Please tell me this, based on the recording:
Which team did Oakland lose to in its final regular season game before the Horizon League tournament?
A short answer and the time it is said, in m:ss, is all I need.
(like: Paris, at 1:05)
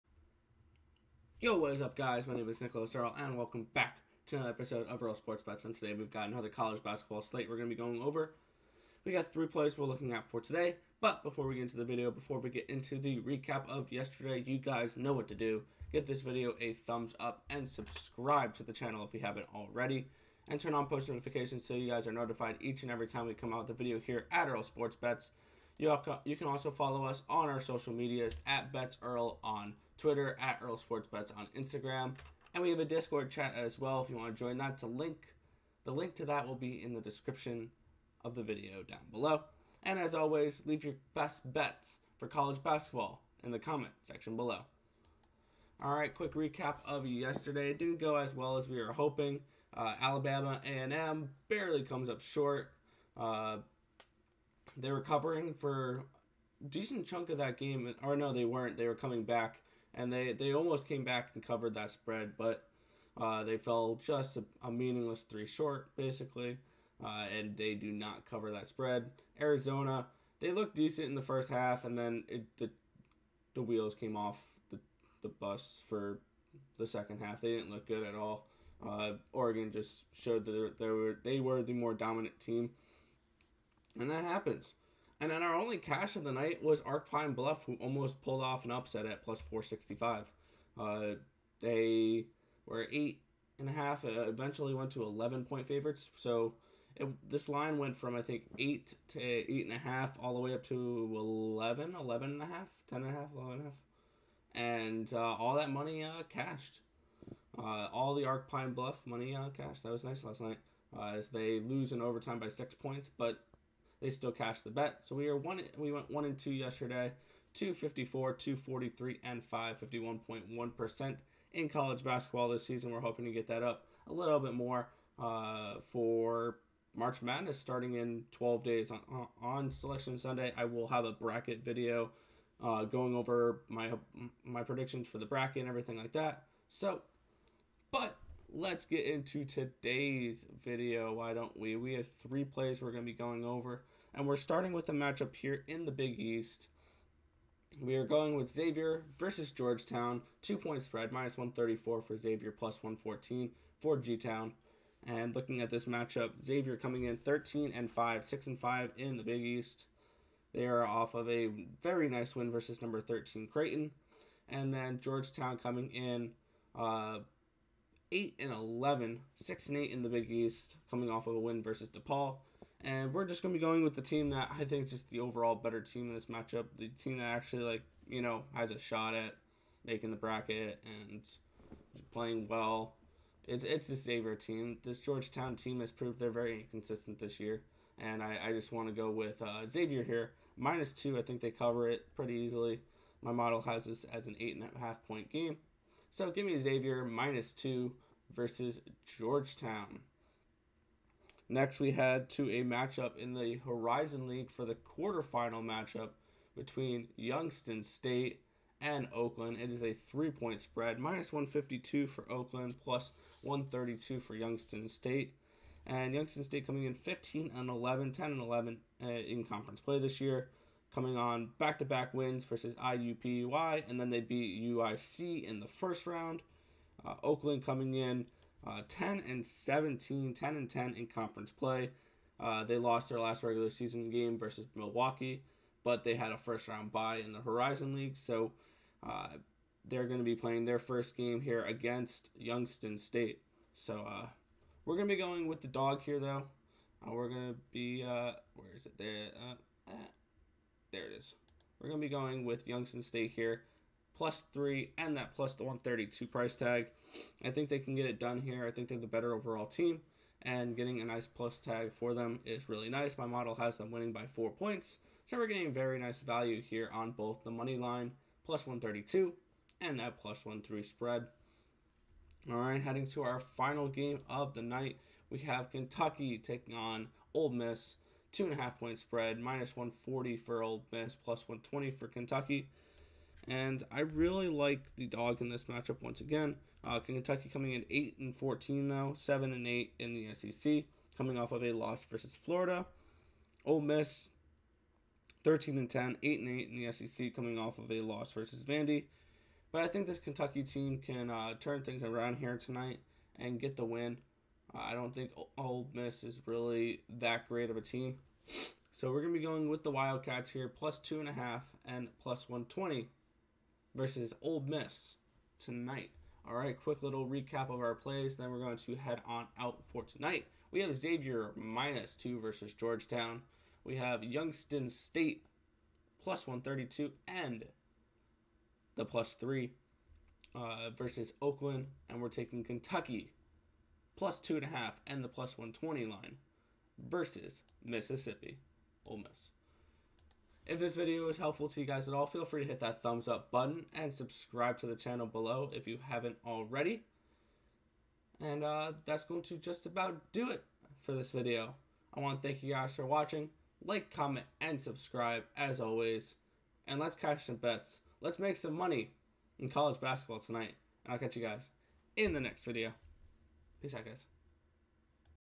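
Milwaukee, at 3:54.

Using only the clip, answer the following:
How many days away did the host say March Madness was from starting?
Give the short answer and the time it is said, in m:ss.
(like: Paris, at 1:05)
12, at 2:08.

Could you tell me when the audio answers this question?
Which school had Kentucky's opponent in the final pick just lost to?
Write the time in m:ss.
4:58.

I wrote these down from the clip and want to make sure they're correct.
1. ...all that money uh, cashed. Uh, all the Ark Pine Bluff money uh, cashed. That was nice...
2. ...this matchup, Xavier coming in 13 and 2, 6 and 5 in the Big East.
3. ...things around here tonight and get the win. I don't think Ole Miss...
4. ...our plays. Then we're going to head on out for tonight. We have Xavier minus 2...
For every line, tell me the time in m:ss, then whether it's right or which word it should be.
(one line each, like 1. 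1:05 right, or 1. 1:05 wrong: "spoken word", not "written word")
1. 1:45 right
2. 2:35 wrong: "5", not "2"
3. 5:01 right
4. 5:17 right.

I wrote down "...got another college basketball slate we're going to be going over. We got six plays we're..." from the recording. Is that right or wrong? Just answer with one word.
wrong.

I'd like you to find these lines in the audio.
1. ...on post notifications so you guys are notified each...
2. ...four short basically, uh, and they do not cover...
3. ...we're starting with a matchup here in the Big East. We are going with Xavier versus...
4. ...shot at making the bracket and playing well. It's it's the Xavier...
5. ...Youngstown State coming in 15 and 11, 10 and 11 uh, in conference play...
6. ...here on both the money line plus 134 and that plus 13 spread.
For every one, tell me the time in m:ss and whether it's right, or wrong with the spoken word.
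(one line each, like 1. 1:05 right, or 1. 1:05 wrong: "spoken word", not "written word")
1. 0:20 right
2. 1:05 wrong: "three", not "four"
3. 2:24 right
4. 2:58 right
5. 3:36 right
6. 4:26 wrong: "132", not "134".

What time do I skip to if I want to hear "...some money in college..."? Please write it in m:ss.
5:58.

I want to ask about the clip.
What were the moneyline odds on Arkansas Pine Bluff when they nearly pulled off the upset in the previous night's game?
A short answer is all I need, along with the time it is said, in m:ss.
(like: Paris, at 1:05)
+465, at 1:29.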